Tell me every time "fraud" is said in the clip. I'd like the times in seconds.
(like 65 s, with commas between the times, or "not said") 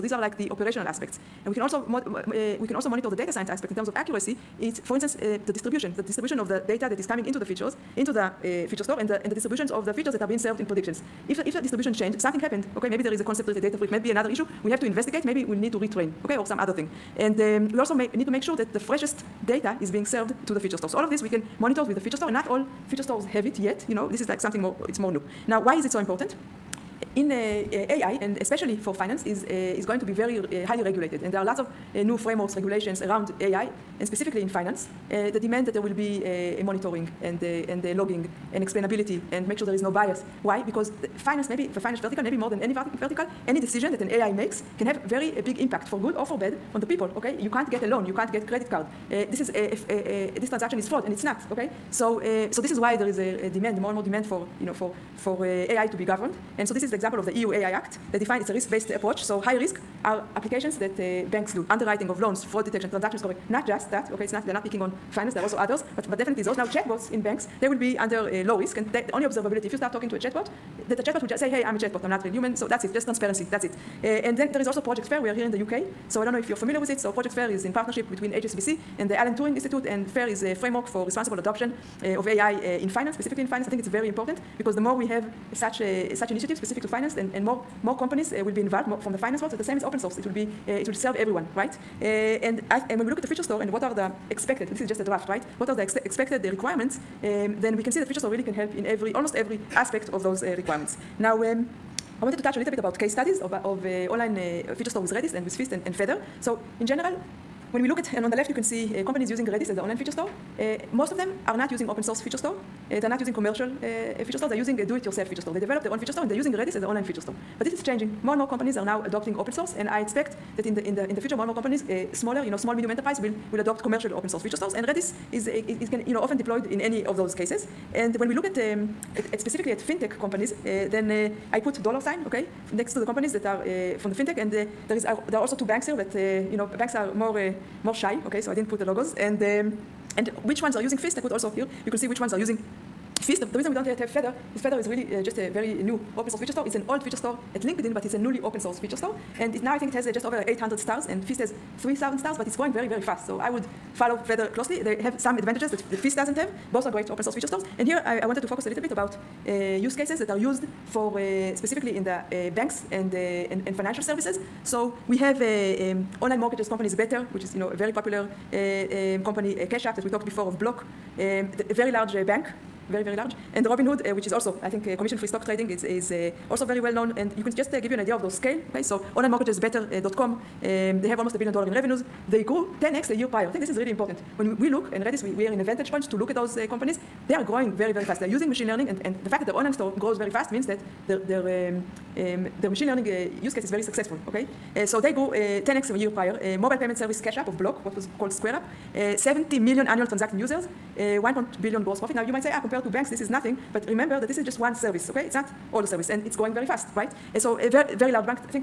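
50 s, 62 s.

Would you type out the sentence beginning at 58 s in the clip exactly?
They define it's a risk-based approach.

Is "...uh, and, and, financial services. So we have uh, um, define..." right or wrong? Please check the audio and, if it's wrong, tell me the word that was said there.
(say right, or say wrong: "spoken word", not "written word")
wrong: "online", not "define".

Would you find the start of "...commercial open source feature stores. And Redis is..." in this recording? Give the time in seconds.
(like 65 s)
123 s.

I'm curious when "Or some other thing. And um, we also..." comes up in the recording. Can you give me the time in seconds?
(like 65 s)
16 s.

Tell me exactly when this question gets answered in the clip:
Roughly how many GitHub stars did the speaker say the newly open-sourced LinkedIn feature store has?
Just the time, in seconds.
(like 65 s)
150 s.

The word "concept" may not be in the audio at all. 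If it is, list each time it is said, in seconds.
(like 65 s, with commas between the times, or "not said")
13 s.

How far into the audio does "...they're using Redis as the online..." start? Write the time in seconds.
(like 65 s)
116 s.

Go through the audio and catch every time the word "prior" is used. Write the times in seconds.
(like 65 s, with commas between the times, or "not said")
183 s, 196 s.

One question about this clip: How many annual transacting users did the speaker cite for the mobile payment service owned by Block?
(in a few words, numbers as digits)
70 million.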